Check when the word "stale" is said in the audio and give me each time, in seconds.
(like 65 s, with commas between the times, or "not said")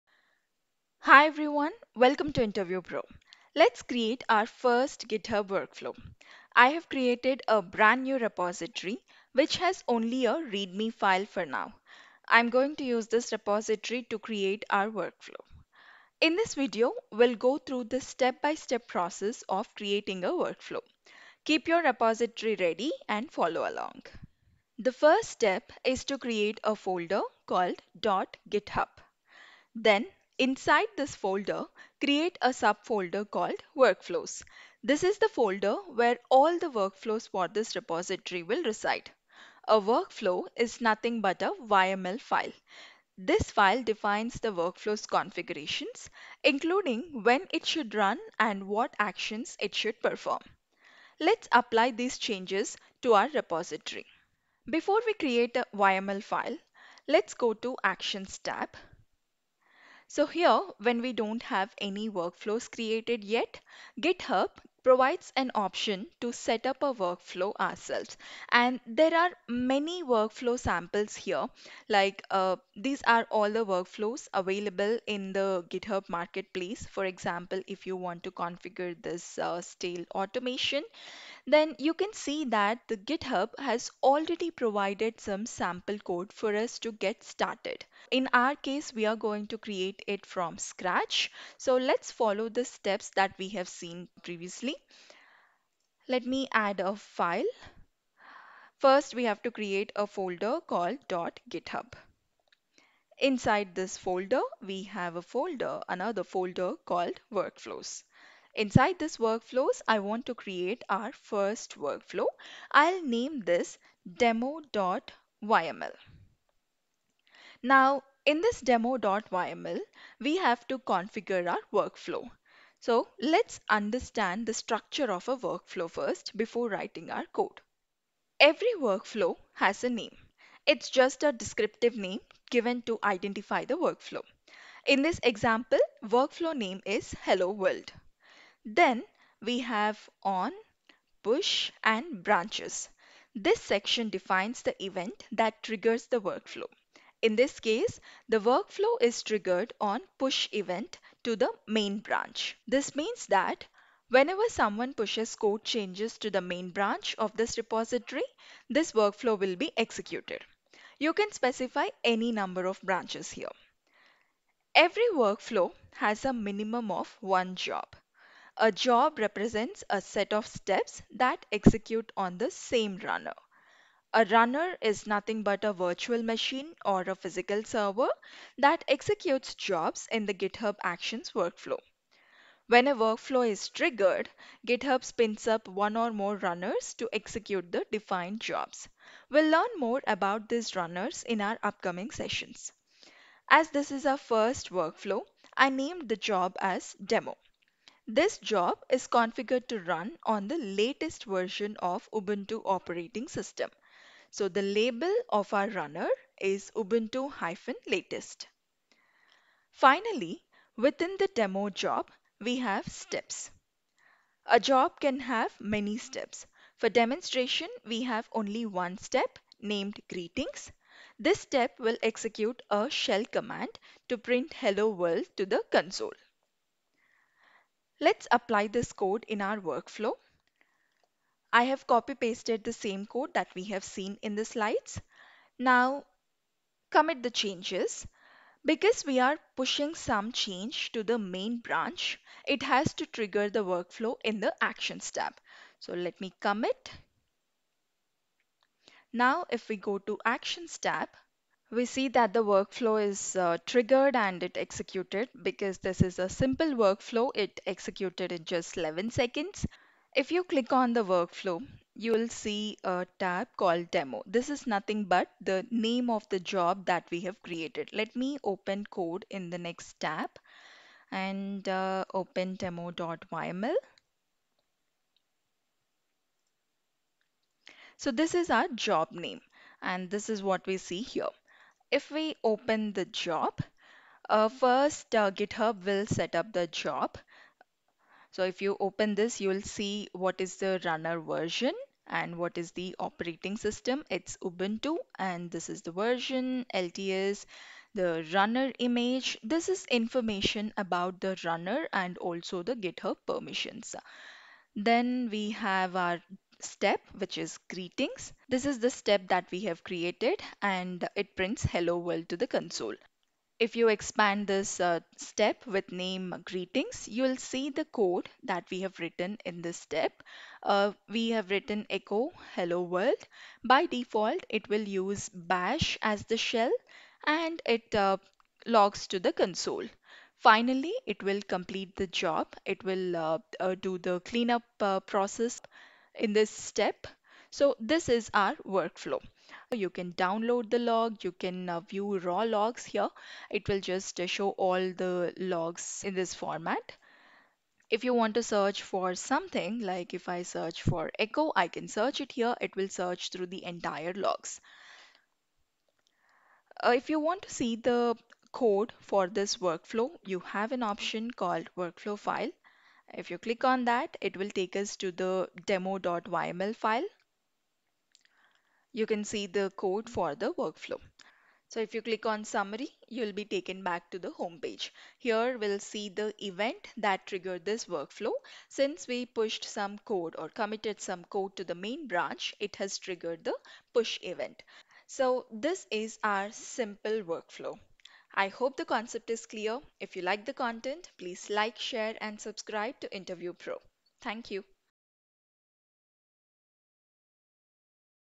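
79 s.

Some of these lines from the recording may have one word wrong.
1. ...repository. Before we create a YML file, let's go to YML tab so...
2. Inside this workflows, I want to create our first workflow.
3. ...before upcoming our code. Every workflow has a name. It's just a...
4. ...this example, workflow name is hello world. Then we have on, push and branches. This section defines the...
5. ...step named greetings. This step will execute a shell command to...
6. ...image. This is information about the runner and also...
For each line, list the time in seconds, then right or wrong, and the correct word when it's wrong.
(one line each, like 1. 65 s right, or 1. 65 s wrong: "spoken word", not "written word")
1. 53 s wrong: "Actions", not "YML"
2. 108 s right
3. 126 s wrong: "writing", not "upcoming"
4. 135 s right
5. 218 s right
6. 298 s right.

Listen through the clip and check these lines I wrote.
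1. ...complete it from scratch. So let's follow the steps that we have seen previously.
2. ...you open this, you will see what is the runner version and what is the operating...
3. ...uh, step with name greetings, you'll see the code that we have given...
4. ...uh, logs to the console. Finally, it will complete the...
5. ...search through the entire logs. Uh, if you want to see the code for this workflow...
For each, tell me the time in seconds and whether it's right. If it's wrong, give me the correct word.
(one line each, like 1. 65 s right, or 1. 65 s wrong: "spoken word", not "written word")
1. 89 s wrong: "create", not "complete"
2. 288 s right
3. 314 s wrong: "written", not "given"
4. 327 s right
5. 352 s right.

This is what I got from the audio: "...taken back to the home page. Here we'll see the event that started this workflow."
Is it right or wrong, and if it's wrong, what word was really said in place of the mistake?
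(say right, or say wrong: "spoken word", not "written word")
wrong: "triggered", not "started".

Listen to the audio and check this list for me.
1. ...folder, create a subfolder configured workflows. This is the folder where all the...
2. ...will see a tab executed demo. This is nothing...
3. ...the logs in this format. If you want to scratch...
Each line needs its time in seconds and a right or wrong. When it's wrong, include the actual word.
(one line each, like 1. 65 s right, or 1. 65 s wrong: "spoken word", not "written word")
1. 31 s wrong: "called", not "configured"
2. 262 s wrong: "called", not "executed"
3. 344 s wrong: "search", not "scratch".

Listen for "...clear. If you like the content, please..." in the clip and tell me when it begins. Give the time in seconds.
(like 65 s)
389 s.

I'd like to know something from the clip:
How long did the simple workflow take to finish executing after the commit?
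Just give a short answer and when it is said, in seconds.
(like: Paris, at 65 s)
11 seconds, at 258 s.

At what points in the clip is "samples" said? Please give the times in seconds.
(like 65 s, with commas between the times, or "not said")
70 s, 85 s.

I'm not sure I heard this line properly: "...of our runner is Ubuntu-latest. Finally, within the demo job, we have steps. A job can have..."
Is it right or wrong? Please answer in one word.
right.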